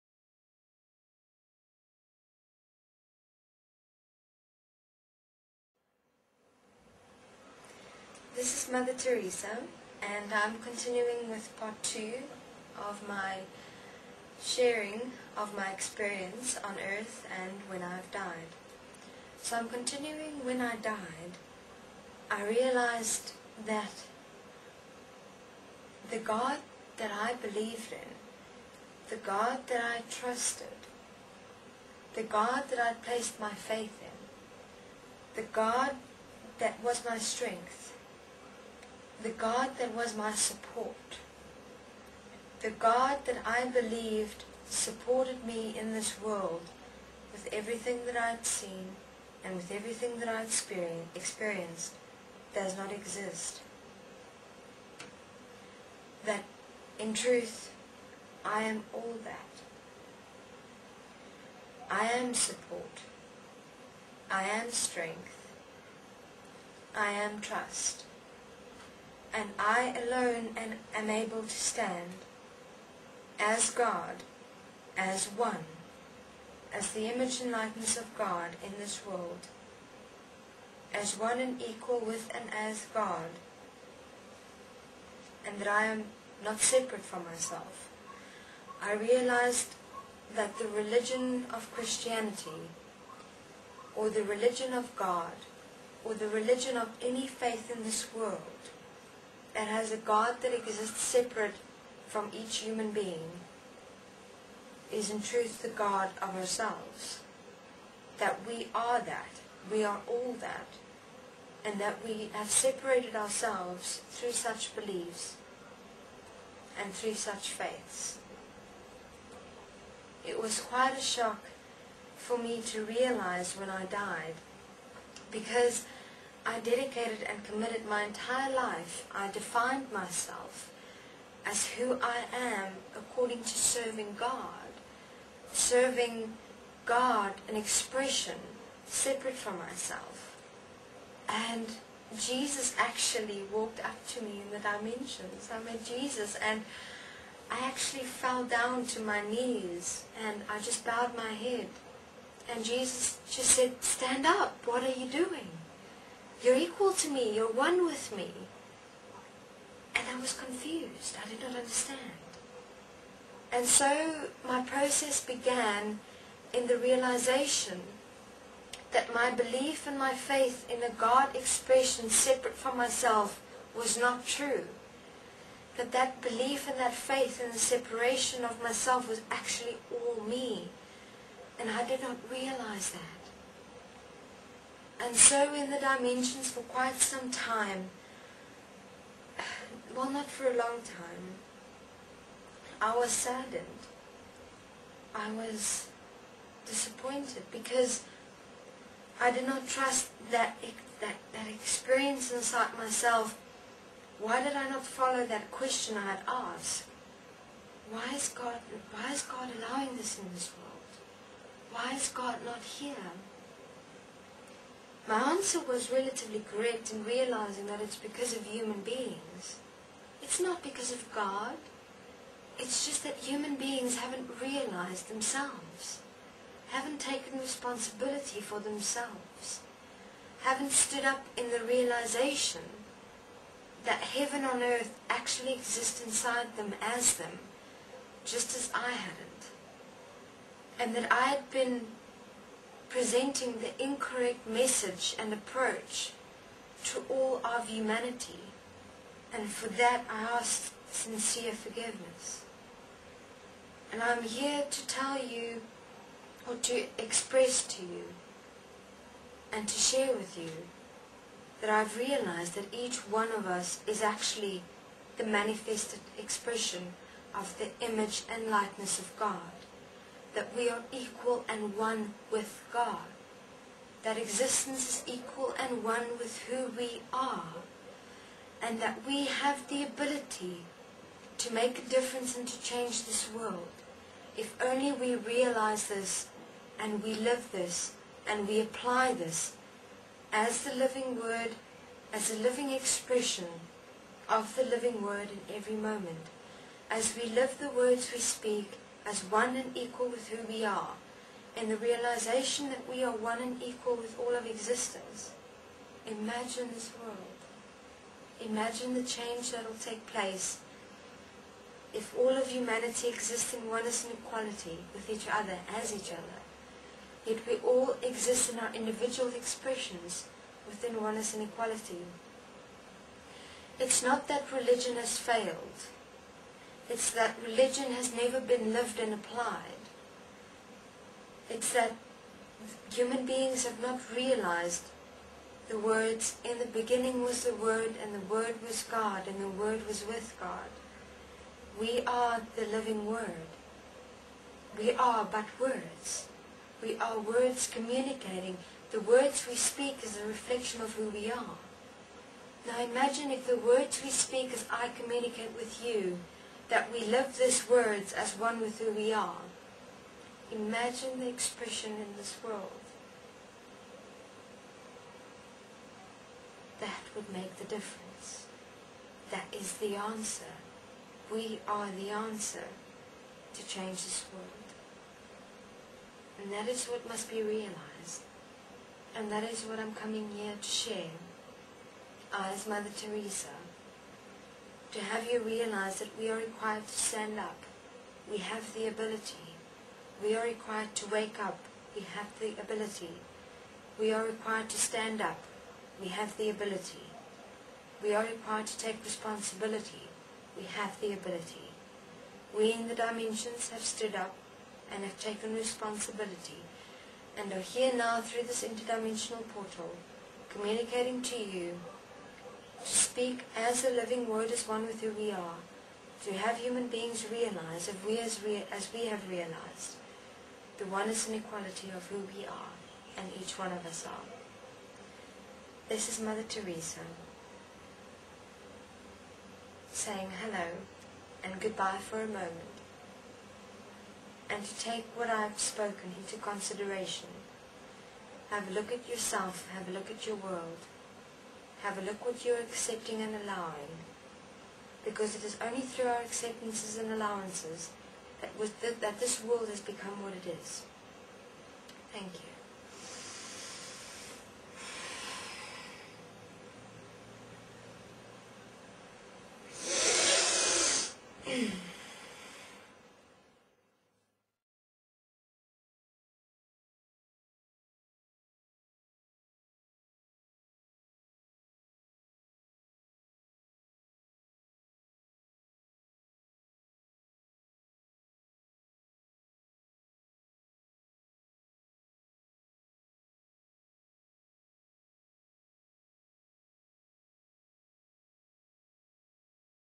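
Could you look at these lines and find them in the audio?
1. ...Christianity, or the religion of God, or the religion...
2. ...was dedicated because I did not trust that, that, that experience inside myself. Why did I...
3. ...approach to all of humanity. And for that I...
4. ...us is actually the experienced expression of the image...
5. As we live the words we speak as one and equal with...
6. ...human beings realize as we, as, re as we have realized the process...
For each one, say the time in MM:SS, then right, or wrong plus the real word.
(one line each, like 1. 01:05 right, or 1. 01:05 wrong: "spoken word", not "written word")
1. 01:31 right
2. 03:15 wrong: "disappointed", not "dedicated"
3. 04:05 right
4. 04:23 wrong: "manifested", not "experienced"
5. 04:56 right
6. 06:56 wrong: "oneness", not "process".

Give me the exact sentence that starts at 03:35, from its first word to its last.
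My answer was relatively correct in realizing that it's because of human beings.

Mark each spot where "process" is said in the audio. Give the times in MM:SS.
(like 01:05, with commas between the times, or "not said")
02:44.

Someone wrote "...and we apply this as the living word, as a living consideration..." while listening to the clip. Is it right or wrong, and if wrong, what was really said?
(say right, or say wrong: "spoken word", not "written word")
wrong: "expression", not "consideration".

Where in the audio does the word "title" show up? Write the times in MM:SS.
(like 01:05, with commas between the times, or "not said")
not said.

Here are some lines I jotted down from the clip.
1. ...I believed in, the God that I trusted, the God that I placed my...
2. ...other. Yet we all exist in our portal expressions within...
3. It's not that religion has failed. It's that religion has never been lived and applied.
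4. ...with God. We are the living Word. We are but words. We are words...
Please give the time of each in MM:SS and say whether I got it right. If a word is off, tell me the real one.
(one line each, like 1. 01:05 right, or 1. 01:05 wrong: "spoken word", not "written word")
1. 00:27 right
2. 05:16 wrong: "individual", not "portal"
3. 05:23 right
4. 05:40 right.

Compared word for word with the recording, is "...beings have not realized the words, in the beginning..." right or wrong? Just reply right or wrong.
right.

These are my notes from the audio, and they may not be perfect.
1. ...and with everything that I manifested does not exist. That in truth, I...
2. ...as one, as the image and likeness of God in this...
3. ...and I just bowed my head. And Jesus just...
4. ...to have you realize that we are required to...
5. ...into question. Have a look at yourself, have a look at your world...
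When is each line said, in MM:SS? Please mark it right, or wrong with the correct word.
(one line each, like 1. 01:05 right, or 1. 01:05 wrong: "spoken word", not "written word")
1. 00:49 wrong: "experienced", not "manifested"
2. 01:14 right
3. 02:30 right
4. 06:24 right
5. 07:16 wrong: "consideration", not "question".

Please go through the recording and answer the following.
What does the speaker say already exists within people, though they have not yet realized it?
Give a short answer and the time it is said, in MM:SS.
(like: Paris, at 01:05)
Heaven on earth, at 03:54.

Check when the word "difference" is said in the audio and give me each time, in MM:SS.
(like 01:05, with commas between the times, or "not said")
04:41, 06:07.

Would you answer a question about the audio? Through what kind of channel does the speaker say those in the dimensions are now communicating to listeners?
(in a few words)
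Interdimensional portal.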